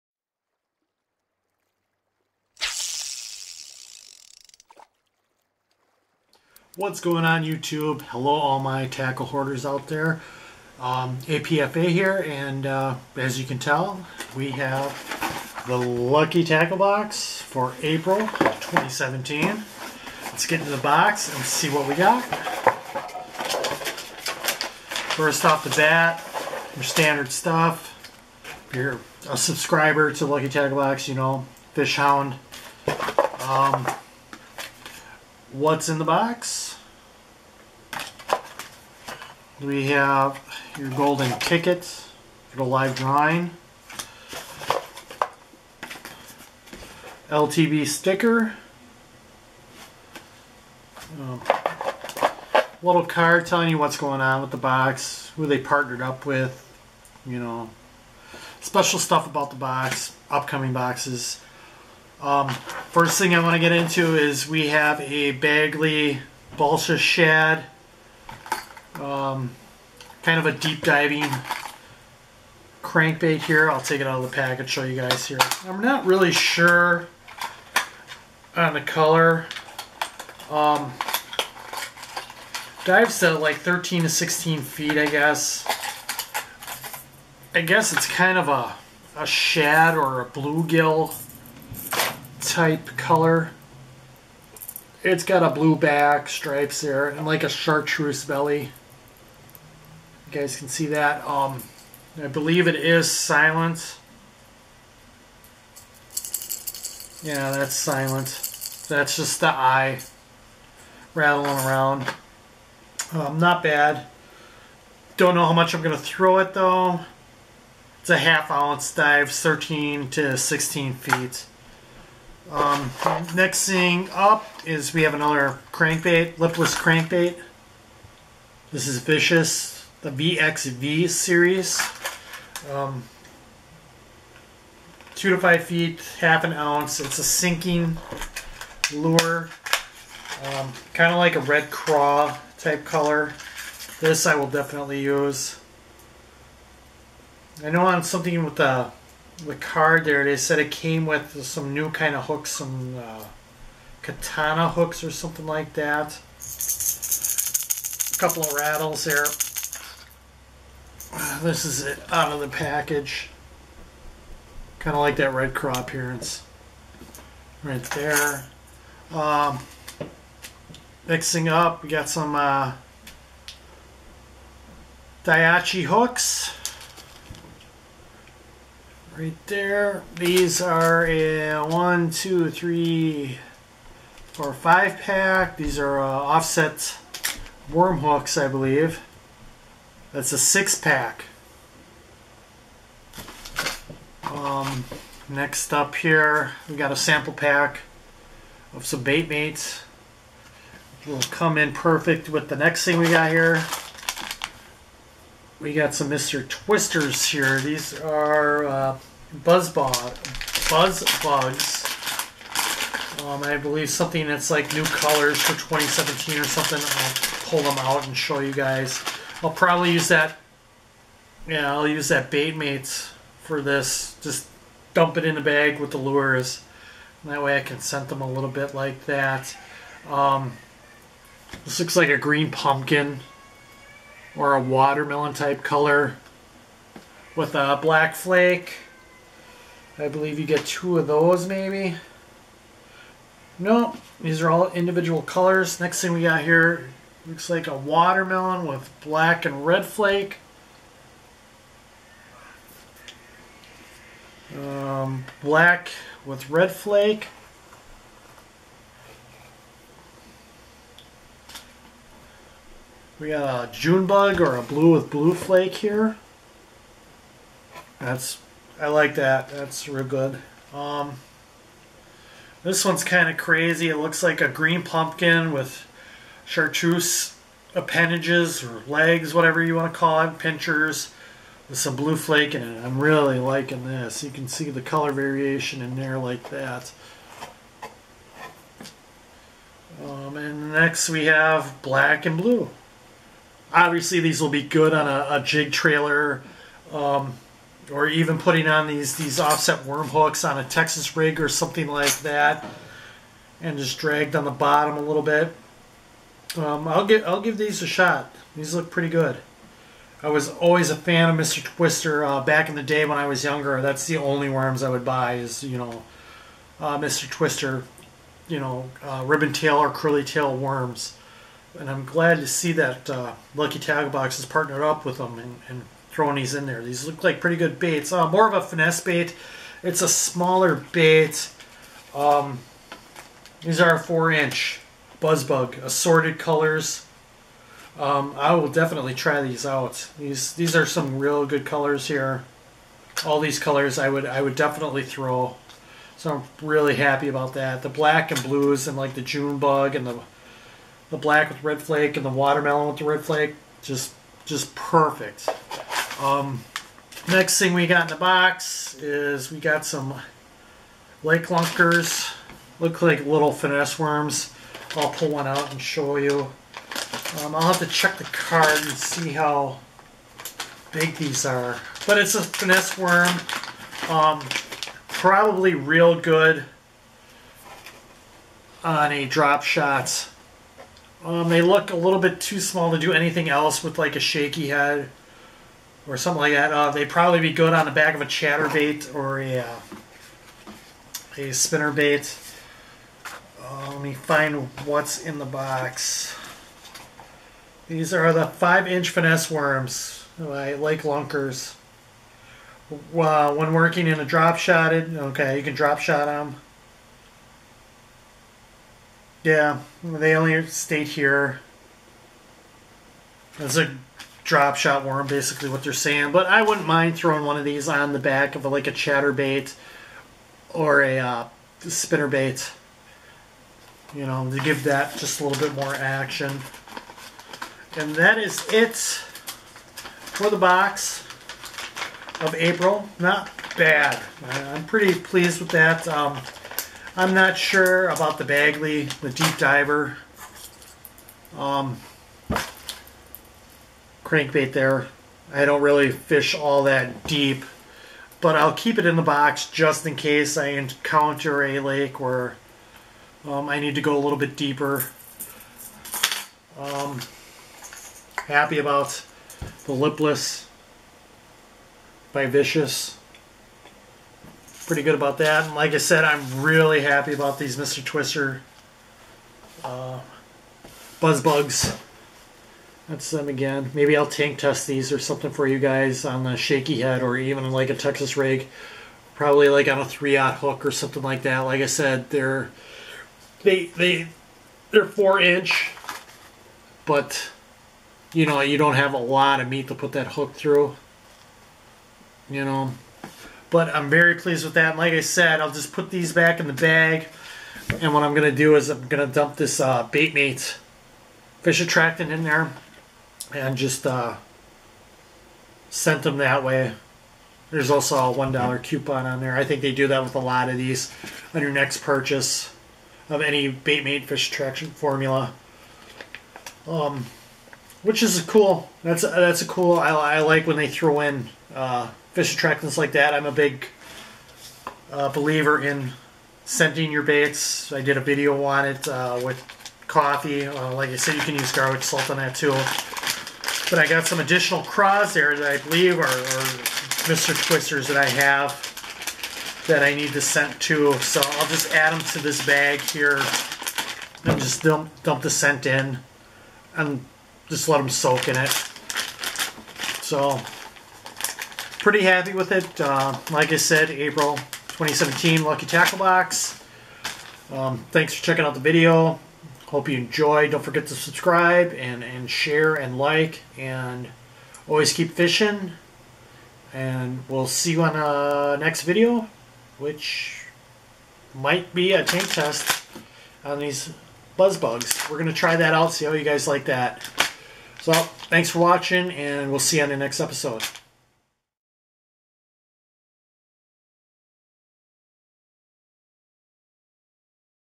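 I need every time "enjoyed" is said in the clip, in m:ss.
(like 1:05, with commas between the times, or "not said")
9:20.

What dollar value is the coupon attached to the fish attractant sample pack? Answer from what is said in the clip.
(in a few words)
$1.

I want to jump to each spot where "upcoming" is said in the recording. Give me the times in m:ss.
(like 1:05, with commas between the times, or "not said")
1:00.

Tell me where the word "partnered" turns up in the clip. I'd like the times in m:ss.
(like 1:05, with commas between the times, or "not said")
0:55, 5:24.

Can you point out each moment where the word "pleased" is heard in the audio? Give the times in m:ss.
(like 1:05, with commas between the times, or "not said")
7:15, 8:14.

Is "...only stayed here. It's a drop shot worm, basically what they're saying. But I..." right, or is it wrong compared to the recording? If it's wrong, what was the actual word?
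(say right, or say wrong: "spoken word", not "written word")
right.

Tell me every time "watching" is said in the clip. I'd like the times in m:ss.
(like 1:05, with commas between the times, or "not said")
9:38.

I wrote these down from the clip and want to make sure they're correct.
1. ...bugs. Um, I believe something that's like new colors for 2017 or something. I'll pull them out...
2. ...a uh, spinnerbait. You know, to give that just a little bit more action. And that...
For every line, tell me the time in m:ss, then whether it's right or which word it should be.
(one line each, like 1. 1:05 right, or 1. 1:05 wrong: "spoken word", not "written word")
1. 3:31 right
2. 7:01 right.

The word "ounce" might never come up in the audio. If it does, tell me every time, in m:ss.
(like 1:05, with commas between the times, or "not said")
1:58, 2:16.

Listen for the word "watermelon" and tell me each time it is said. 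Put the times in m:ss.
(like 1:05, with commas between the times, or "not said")
3:54, 4:07, 5:52.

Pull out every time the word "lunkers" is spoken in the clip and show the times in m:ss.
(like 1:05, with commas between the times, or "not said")
6:01, 6:41.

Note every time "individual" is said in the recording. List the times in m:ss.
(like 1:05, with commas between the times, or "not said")
4:04.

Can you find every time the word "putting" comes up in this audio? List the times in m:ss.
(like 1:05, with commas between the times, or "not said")
4:58.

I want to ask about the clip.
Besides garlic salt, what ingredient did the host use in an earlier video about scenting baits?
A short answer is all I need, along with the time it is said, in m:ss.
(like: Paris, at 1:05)
coffee, at 8:50.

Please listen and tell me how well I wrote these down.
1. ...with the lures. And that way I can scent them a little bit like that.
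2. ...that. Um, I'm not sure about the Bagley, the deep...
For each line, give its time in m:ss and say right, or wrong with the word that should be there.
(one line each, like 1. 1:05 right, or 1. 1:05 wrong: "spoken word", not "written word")
1. 3:45 right
2. 7:15 right.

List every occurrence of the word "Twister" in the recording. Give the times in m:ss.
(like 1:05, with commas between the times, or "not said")
3:26, 5:11, 5:17, 7:48, 8:57.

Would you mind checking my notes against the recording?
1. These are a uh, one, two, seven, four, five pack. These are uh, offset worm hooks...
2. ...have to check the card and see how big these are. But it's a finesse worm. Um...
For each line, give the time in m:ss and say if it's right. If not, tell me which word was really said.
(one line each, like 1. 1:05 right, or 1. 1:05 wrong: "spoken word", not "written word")
1. 3:00 wrong: "three", not "seven"
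2. 6:07 right.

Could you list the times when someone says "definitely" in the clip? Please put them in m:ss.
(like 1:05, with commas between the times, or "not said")
2:24, 5:38, 5:44.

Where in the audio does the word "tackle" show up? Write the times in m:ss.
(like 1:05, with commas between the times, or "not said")
0:08, 0:16, 0:30, 5:23, 9:15.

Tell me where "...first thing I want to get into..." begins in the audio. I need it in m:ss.
1:02.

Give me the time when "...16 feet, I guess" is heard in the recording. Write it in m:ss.
1:24.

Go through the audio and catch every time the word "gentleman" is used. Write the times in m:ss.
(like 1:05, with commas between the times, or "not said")
not said.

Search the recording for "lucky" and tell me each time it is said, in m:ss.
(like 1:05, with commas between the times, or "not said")
0:15, 0:30, 5:23, 9:15.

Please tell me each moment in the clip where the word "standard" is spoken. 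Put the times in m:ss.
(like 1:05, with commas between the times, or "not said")
0:26.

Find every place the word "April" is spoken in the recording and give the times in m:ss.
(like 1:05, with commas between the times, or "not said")
0:17, 7:12, 9:14.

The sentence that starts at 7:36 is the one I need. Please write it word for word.
Um, happy about the Lipless by Vicious pretty good about that.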